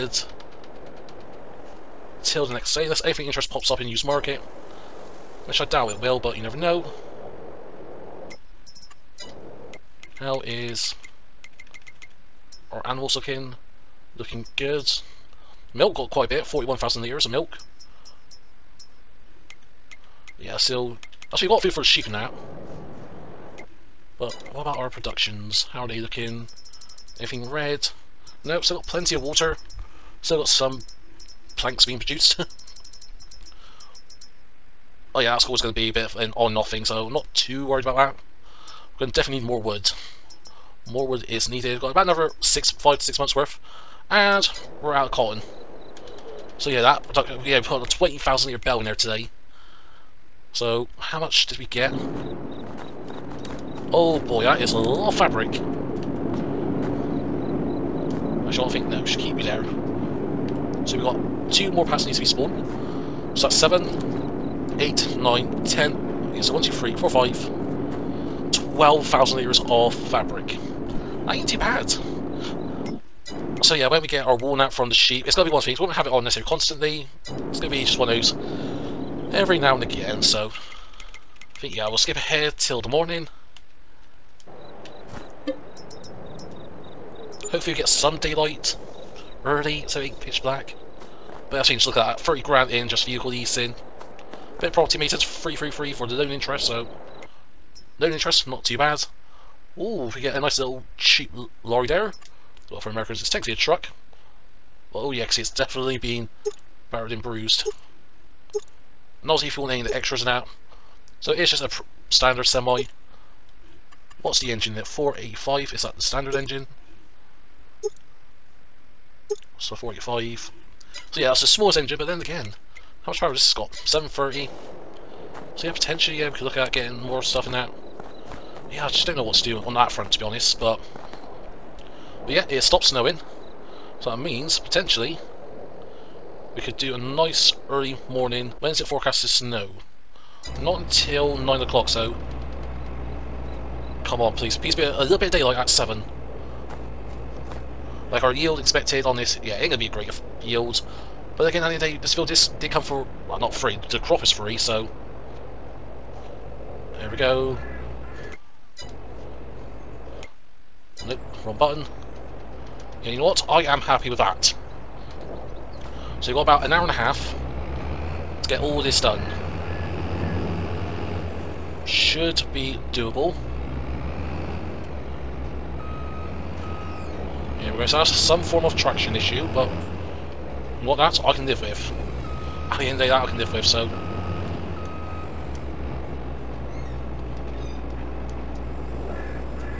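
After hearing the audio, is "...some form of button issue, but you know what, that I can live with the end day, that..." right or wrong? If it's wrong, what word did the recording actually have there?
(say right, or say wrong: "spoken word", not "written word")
wrong: "traction", not "button".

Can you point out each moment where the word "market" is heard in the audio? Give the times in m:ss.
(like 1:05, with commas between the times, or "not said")
0:04.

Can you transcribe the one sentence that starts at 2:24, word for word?
Please be a, little bit of daylight at 7.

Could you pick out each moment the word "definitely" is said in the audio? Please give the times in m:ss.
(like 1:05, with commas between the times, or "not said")
0:39, 1:45.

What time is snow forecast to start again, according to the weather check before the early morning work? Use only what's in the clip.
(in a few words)
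9 o'clock.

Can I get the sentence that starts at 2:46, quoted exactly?
So you've got about an hour and a half to get all this done.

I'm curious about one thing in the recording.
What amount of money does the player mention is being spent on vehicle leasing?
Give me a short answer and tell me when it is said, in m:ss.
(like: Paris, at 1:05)
30 grand, at 1:32.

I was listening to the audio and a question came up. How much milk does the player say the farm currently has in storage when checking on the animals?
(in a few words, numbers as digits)
41,000 litres.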